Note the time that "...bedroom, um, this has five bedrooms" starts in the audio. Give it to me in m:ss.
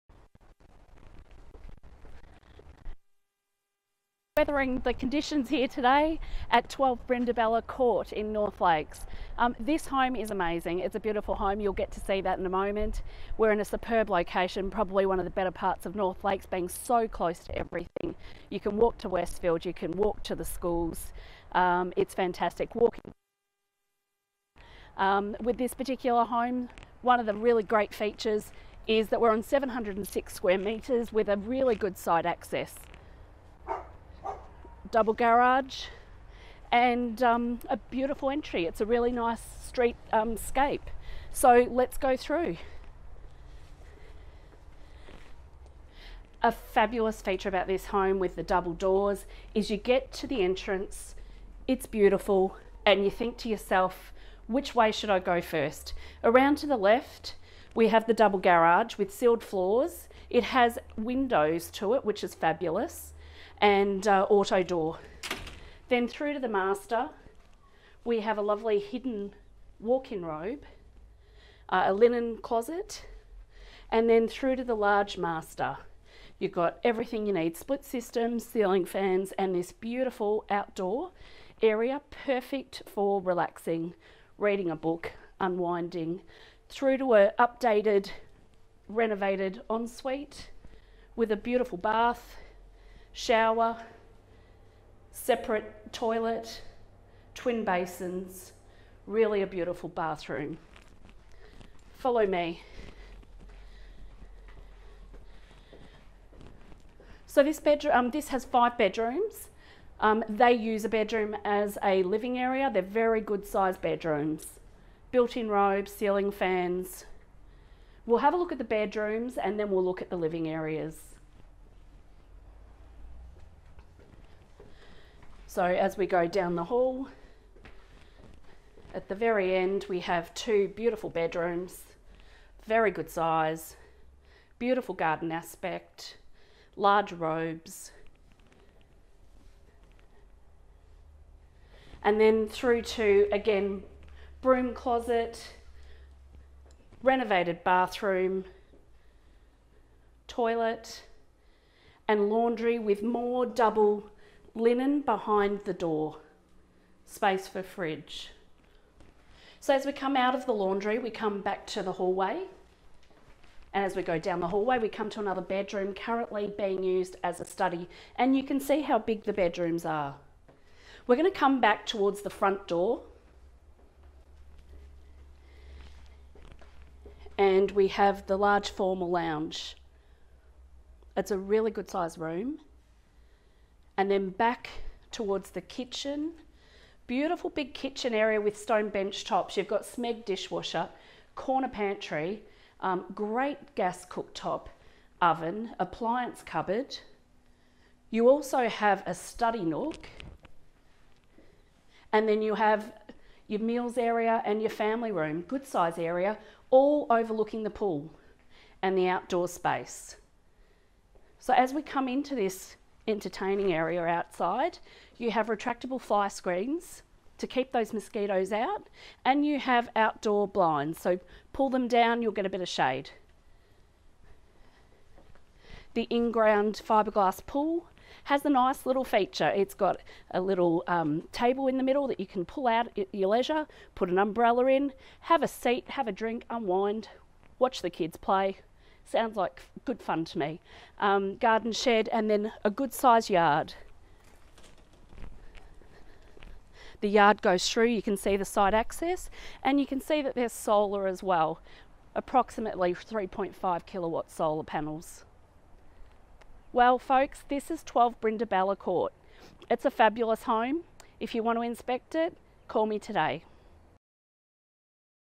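1:47.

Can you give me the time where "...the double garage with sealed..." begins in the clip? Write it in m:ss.
0:58.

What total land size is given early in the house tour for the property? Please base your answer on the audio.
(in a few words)
706 square metres.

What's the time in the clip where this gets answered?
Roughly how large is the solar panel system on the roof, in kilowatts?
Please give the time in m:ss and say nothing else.
4:12.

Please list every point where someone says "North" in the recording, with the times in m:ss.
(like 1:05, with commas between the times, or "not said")
0:08, 0:15.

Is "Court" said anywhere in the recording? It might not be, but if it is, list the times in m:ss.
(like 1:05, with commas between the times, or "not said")
0:07, 4:18.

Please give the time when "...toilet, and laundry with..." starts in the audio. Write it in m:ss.
2:30.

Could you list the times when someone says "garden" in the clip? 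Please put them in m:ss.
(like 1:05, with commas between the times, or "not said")
2:14, 4:01.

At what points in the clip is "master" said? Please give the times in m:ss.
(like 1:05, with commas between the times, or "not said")
1:06, 1:15.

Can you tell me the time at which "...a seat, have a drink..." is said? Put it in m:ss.
3:55.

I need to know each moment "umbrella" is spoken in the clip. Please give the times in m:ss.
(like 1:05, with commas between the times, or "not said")
3:54.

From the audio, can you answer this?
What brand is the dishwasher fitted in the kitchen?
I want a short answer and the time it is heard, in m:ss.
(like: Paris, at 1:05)
Smeg, at 3:09.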